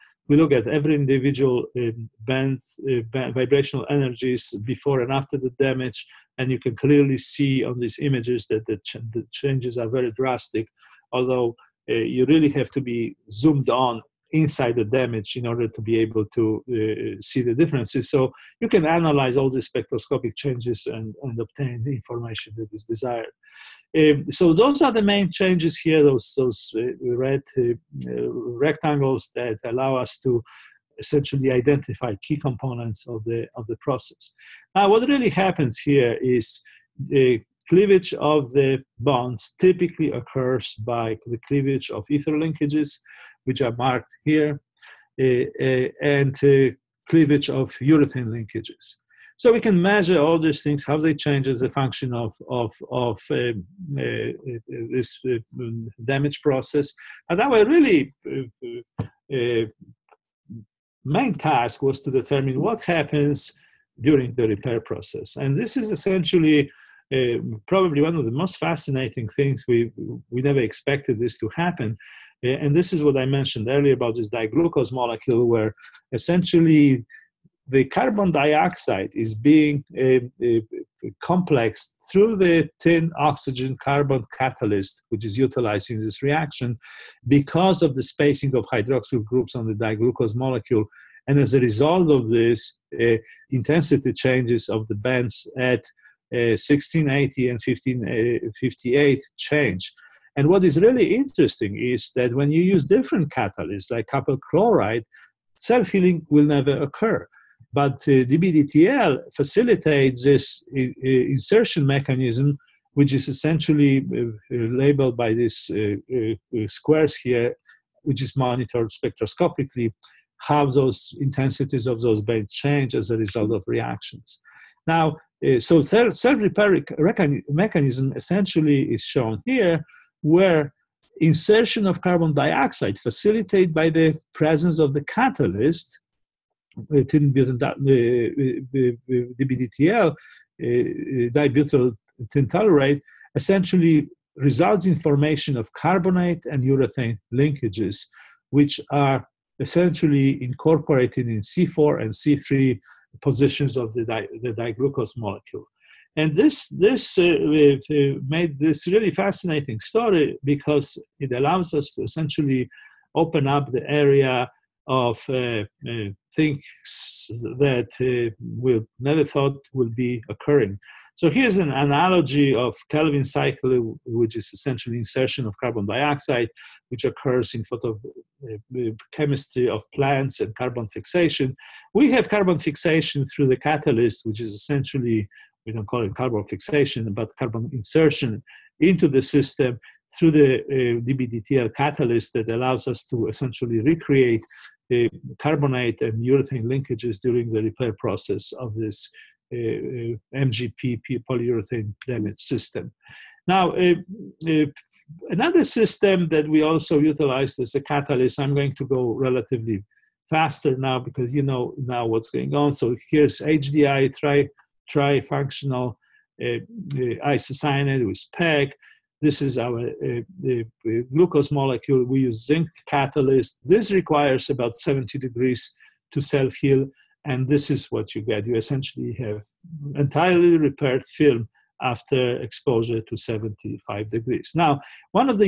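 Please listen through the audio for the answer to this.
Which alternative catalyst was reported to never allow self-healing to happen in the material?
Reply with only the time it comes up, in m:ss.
1:44.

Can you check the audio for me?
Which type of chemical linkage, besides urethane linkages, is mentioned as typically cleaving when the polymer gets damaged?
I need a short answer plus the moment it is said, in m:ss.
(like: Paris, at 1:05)
ether linkages, at 0:42.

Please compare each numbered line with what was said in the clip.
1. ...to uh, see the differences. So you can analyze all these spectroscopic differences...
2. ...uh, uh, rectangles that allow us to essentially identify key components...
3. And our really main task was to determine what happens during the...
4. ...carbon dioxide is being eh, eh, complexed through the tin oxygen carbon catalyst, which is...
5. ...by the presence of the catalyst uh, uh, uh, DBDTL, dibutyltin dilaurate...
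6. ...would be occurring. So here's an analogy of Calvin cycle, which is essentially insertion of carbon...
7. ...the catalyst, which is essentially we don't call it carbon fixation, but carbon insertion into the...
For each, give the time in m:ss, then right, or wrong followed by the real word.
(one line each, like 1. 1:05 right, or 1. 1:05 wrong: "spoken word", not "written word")
1. 0:16 wrong: "changes", not "differences"
2. 0:27 right
3. 0:57 right
4. 1:17 right
5. 2:13 right
6. 2:49 right
7. 3:03 right.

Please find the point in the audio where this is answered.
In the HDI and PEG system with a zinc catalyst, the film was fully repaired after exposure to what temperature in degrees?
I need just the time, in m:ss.
3:53.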